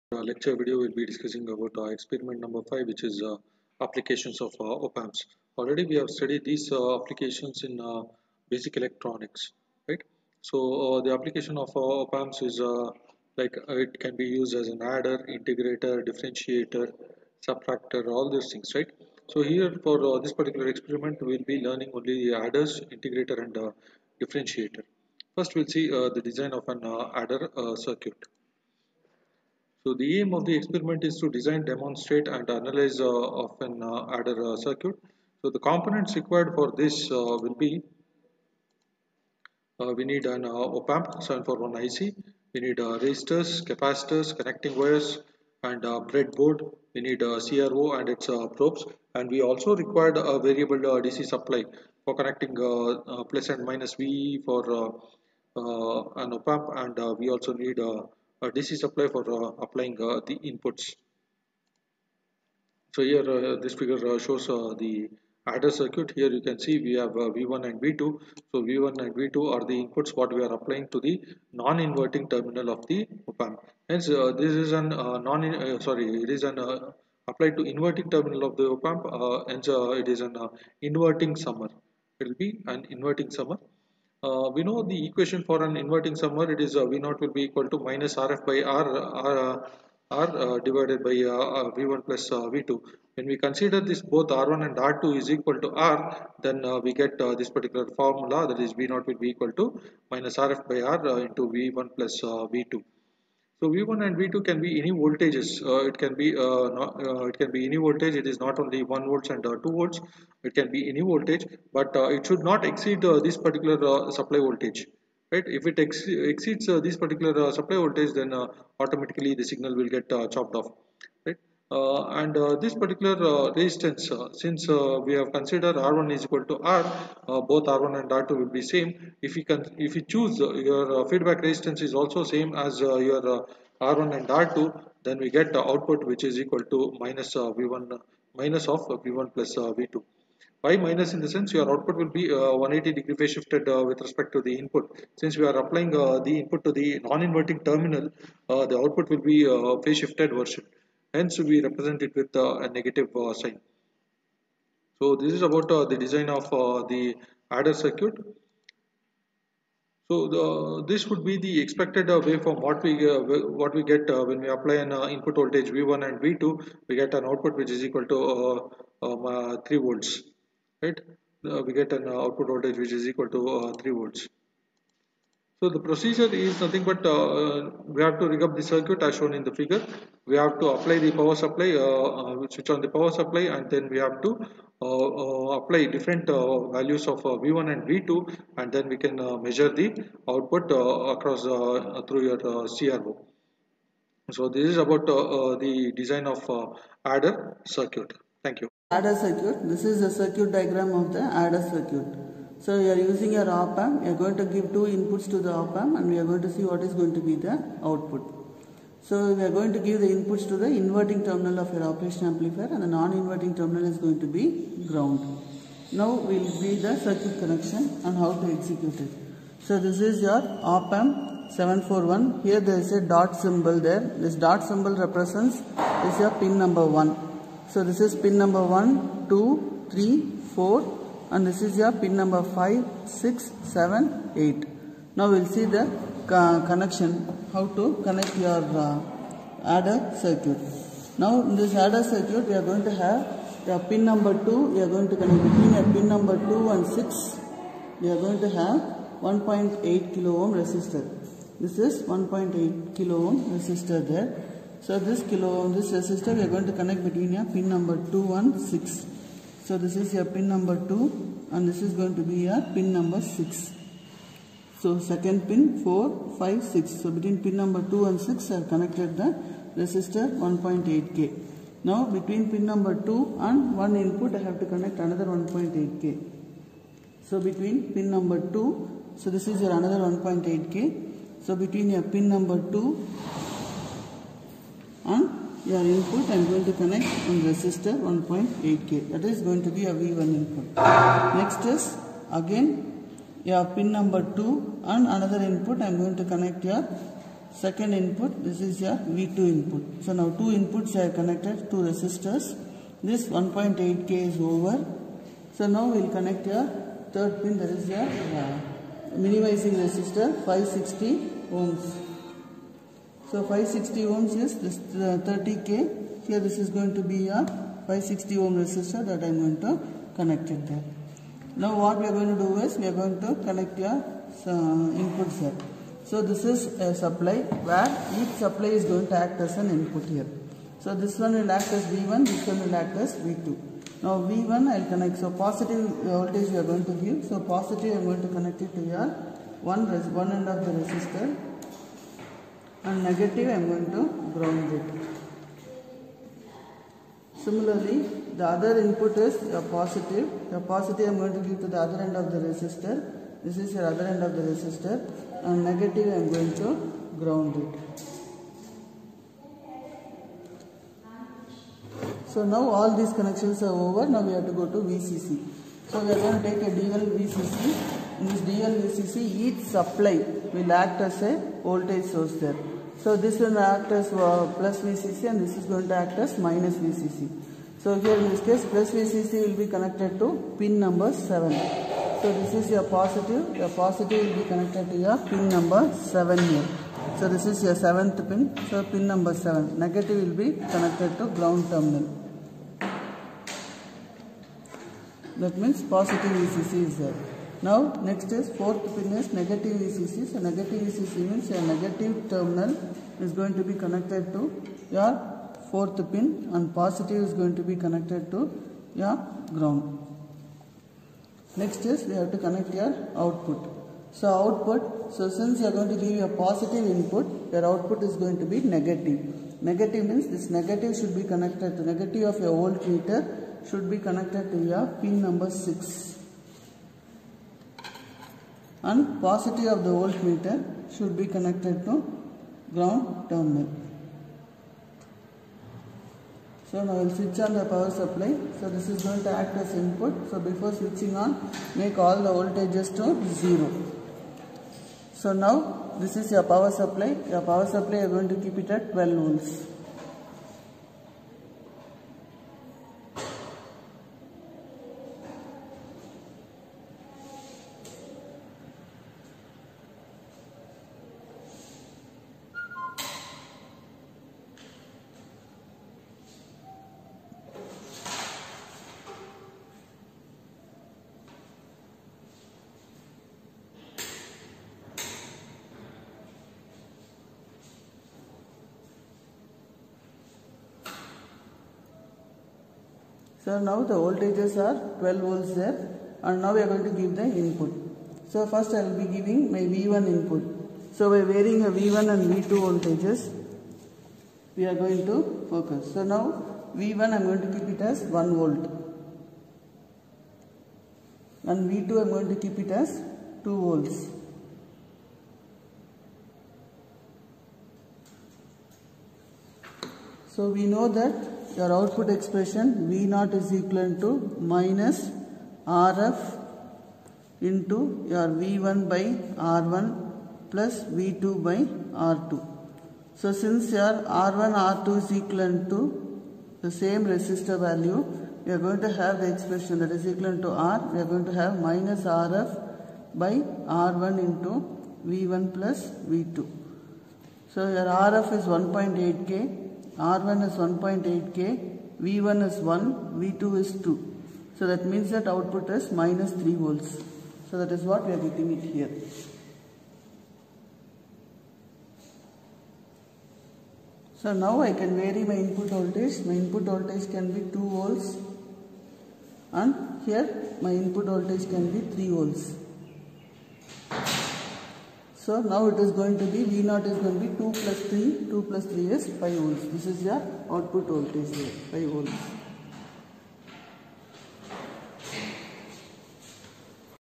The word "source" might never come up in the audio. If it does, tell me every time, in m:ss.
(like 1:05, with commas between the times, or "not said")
6:12.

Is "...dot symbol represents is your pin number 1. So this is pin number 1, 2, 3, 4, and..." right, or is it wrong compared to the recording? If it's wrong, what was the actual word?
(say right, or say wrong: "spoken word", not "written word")
right.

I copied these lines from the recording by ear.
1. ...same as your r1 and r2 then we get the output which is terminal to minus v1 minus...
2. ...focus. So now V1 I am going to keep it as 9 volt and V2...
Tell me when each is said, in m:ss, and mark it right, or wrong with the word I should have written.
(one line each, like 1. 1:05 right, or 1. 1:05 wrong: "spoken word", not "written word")
1. 2:12 wrong: "equal", not "terminal"
2. 8:15 wrong: "1", not "9".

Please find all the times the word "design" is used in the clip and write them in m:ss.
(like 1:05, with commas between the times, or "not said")
0:26, 0:31, 2:35, 3:15.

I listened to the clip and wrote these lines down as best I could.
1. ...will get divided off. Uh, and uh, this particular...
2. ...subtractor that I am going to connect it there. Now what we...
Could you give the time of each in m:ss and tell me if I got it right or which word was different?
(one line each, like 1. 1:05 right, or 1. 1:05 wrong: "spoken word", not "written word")
1. 1:59 wrong: "chopped", not "divided"
2. 5:18 wrong: "resistor", not "subtractor".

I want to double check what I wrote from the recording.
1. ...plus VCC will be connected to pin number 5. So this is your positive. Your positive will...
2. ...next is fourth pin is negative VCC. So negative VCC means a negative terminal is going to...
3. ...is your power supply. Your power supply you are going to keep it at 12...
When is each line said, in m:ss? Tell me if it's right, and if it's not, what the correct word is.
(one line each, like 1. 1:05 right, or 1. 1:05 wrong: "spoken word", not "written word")
1. 6:18 wrong: "7", not "5"
2. 6:38 right
3. 7:26 right.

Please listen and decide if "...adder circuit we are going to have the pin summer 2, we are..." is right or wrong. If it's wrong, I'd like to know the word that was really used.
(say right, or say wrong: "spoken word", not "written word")
wrong: "number", not "summer".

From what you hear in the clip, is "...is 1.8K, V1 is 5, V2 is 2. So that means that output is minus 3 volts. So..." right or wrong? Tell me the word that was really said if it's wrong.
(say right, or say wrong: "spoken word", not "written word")
wrong: "1", not "5".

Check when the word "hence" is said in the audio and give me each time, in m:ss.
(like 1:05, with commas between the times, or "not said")
1:13, 1:19, 2:31.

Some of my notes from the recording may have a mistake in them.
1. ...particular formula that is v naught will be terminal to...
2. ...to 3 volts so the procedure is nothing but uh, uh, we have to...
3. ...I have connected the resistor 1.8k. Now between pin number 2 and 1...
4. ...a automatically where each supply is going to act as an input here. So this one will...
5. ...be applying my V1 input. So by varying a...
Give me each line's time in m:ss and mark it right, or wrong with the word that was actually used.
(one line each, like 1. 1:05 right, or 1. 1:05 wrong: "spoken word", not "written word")
1. 1:37 wrong: "equal", not "terminal"
2. 2:53 right
3. 4:28 right
4. 5:26 wrong: "supply", not "automatically"
5. 8:08 wrong: "giving", not "applying".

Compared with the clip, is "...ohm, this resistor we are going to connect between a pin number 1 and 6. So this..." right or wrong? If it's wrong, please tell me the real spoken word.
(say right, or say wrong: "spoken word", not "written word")
wrong: "2", not "1".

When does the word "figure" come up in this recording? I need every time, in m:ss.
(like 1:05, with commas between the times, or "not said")
1:03, 2:59.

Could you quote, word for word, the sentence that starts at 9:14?
So now I can vary my input voltage.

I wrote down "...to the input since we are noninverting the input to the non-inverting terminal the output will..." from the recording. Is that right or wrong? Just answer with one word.
wrong.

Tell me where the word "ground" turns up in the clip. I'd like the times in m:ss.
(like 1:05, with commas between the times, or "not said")
3:34, 5:44, 5:57, 6:31, 6:49, 7:12.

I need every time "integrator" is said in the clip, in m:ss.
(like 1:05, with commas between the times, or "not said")
0:15, 0:22.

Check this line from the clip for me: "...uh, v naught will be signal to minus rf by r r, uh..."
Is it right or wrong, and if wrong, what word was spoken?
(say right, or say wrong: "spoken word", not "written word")
wrong: "equal", not "signal".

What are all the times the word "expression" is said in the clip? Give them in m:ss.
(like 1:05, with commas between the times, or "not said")
8:32, 8:49.